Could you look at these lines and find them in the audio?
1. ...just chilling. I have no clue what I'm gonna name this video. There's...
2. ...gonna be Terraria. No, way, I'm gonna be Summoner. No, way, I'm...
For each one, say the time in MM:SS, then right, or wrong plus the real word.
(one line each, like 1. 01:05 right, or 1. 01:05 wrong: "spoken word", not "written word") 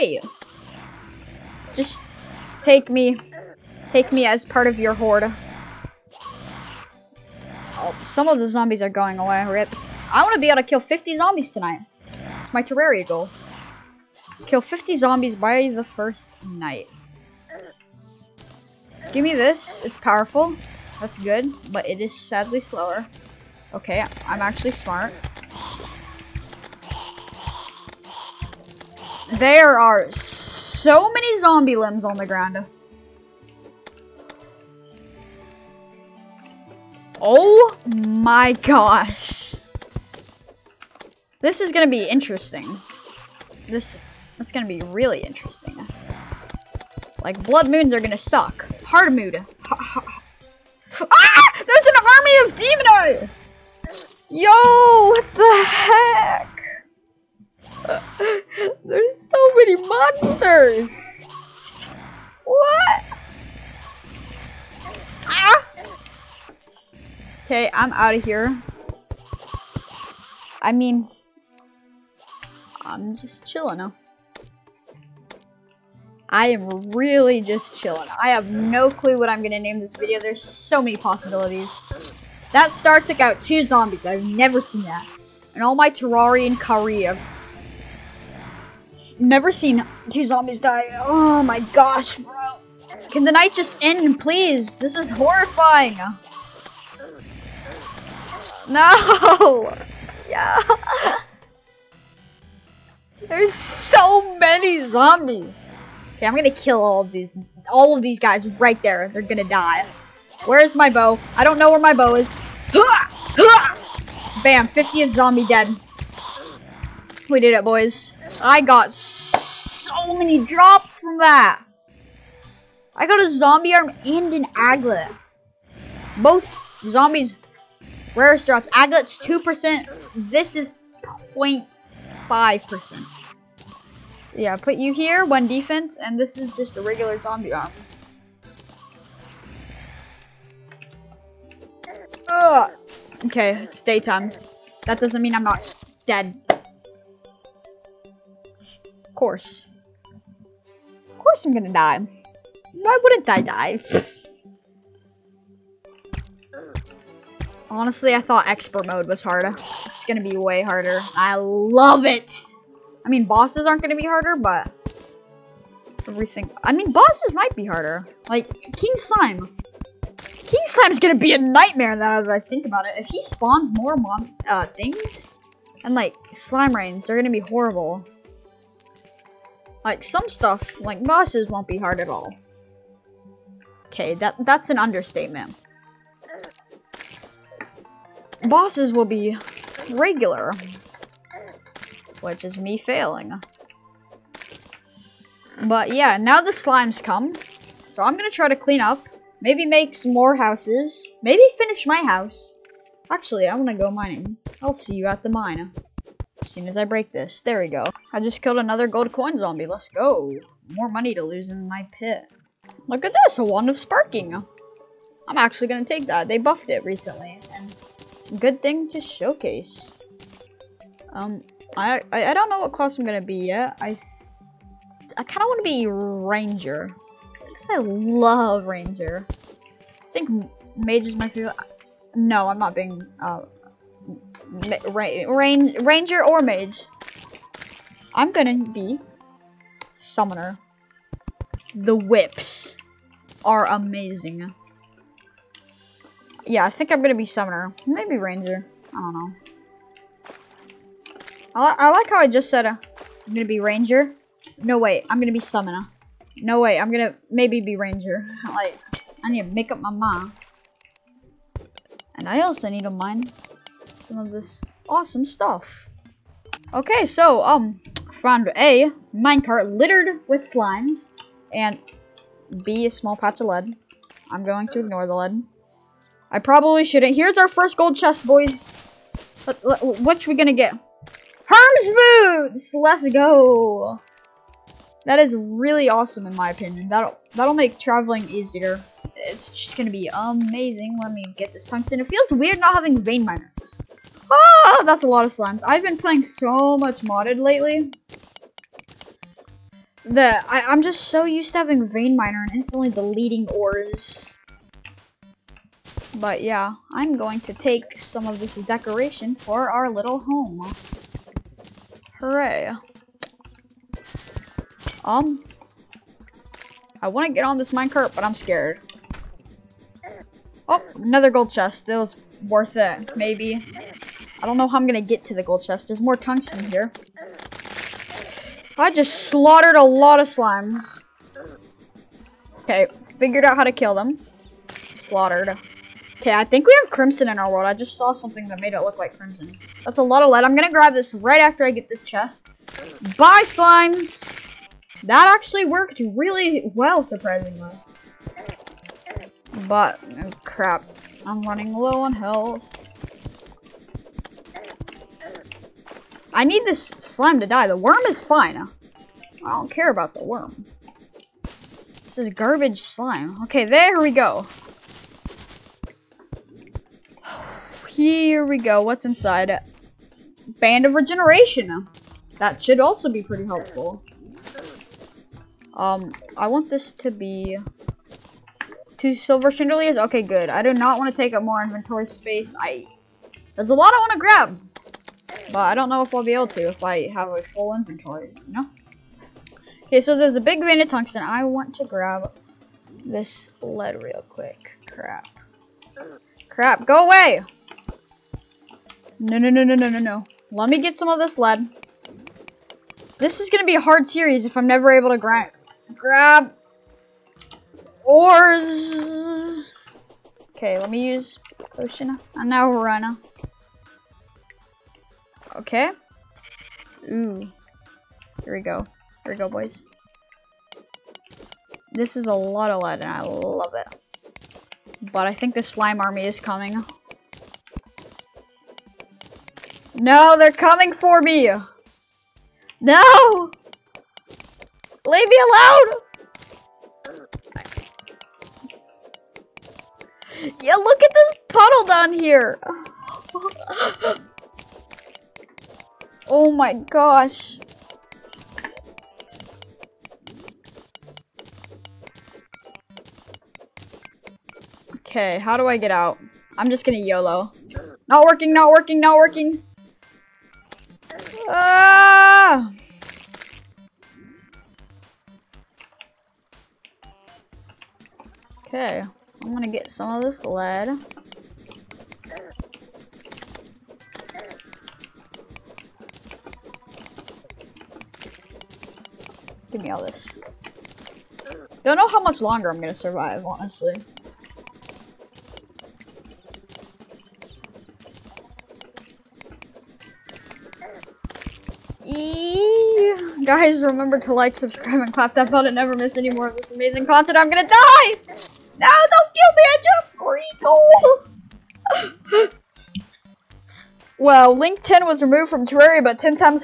1. 01:17 right
2. 04:13 wrong: "Ranger", not "Terraria".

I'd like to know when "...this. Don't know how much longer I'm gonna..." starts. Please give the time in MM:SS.
08:00.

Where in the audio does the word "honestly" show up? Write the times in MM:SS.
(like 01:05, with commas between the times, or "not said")
02:37, 08:03.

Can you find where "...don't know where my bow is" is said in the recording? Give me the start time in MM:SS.
01:51.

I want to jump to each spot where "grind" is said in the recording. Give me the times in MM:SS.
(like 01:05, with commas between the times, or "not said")
06:45.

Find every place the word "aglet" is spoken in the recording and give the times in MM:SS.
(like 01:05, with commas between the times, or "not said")
02:04, 02:08.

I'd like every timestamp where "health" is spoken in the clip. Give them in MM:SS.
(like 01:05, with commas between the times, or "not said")
05:52.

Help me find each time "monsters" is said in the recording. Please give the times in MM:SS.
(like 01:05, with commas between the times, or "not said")
00:59.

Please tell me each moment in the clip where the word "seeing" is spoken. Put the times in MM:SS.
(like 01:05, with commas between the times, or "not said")
not said.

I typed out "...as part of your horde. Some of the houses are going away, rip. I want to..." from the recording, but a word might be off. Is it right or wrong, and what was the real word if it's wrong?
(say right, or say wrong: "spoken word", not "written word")
wrong: "zombies", not "houses".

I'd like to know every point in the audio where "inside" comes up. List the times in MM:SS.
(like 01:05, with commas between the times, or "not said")
06:09.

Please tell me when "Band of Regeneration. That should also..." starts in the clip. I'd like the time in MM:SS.
06:10.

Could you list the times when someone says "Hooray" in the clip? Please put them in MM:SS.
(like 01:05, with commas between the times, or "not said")
05:12.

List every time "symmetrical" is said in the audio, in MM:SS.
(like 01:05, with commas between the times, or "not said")
not said.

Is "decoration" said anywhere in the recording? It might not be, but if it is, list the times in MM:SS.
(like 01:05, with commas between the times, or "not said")
05:08.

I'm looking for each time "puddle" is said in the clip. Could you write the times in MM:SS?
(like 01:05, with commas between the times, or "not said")
07:21.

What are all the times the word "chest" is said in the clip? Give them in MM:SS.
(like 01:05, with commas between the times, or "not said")
04:37, 05:21, 05:25, 05:42.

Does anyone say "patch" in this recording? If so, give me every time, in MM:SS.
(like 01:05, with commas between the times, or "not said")
04:33.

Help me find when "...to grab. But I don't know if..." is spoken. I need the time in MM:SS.
06:24.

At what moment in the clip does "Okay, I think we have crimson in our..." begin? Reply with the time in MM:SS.
05:36.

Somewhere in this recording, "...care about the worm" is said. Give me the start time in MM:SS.
05:59.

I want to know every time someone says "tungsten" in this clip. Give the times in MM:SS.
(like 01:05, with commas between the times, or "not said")
04:51, 05:26, 06:30.